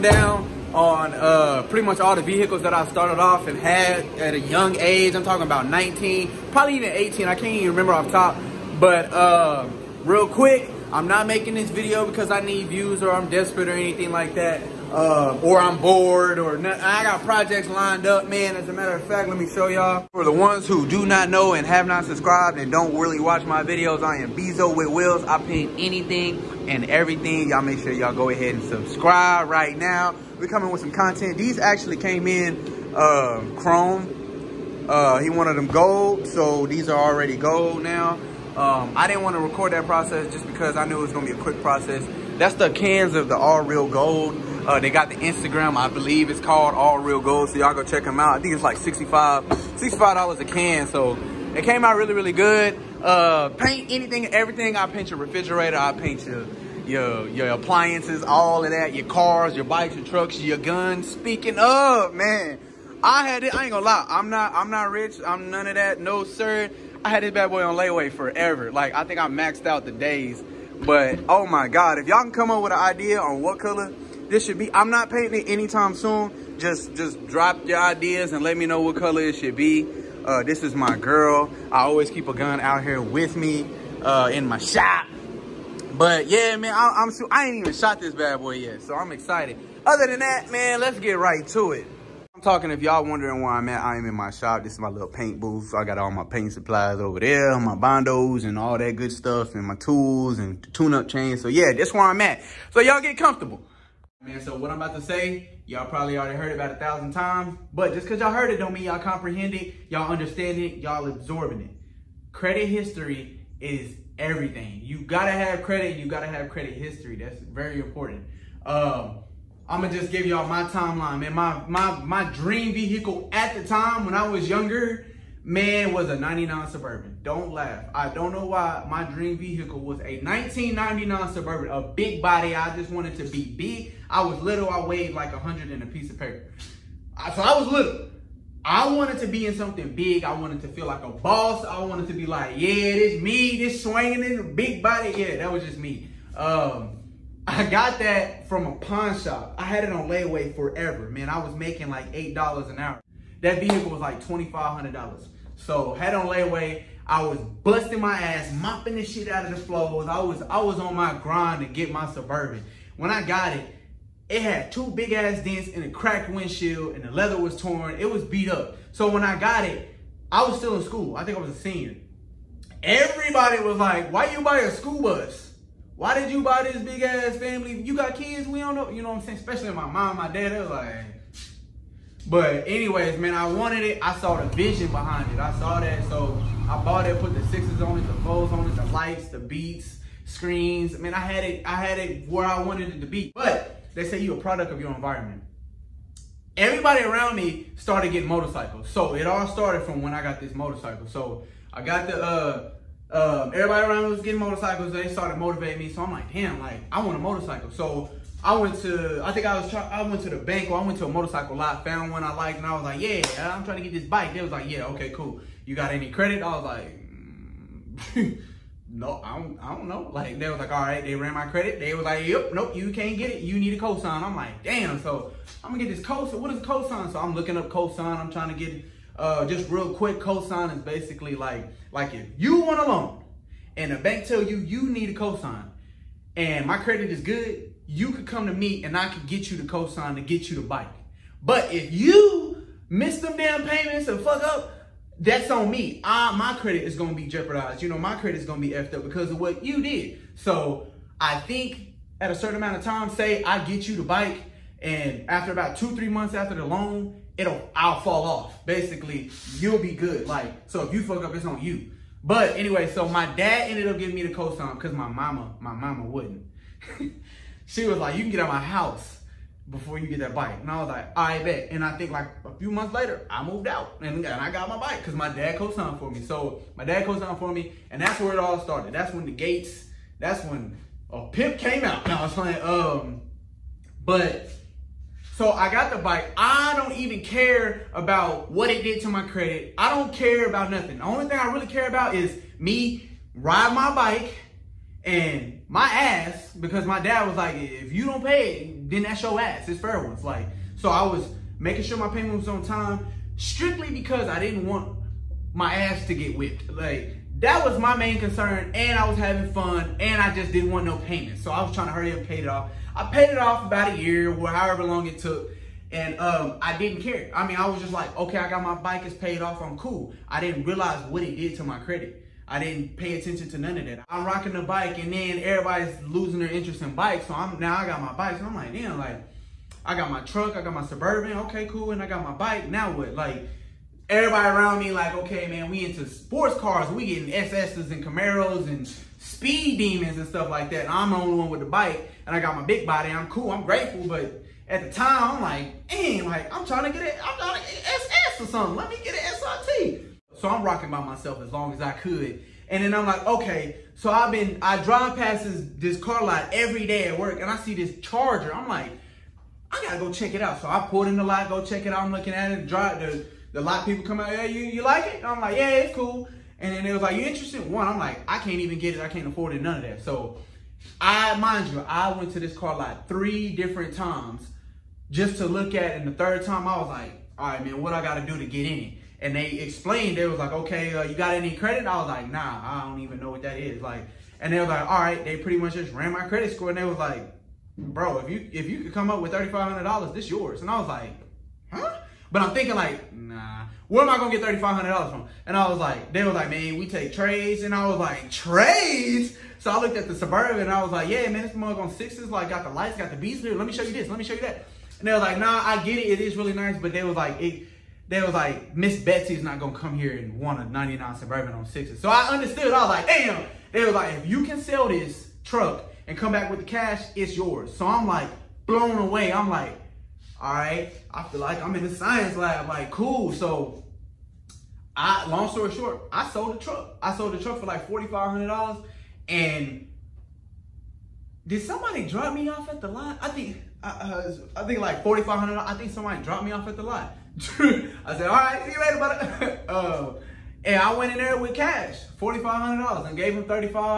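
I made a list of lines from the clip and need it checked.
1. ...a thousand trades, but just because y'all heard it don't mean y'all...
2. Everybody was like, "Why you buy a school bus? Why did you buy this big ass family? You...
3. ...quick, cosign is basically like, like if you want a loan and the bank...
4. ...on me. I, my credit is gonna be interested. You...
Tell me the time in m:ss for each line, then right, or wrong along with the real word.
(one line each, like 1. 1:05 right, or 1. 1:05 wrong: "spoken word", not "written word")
1. 1:46 wrong: "times", not "trades"
2. 2:52 right
3. 3:49 right
4. 4:05 wrong: "jeopardized", not "interested".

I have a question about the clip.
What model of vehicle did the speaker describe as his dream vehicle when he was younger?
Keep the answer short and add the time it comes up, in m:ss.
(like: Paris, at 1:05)
1999 Suburban, at 2:10.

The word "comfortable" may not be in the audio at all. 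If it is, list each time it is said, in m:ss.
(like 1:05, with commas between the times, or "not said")
1:43.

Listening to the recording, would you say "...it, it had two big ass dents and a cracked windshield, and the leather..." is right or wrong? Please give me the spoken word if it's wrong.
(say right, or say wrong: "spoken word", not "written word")
right.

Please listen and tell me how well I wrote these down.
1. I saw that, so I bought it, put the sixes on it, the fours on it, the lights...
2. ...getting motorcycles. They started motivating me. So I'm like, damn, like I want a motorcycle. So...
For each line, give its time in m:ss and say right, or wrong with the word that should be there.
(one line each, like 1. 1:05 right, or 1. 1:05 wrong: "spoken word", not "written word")
1. 3:05 right
2. 3:24 right.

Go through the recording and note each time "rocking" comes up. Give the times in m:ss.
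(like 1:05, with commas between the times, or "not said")
5:24, 5:50.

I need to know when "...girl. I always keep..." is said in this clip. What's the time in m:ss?
1:20.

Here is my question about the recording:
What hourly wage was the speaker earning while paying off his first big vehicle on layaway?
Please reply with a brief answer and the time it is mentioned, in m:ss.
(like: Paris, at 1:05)
$8 an hour, at 2:32.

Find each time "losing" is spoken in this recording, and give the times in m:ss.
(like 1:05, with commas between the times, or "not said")
5:26.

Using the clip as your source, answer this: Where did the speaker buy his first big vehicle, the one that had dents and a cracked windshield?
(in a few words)
a pawn shop.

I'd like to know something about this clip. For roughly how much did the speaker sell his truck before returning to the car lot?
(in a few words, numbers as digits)
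$4,500.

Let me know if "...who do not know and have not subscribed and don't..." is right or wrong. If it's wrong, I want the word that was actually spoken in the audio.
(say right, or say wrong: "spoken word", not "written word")
right.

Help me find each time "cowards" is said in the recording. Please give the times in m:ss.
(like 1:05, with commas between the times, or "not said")
not said.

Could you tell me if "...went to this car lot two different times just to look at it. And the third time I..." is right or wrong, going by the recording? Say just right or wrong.
wrong.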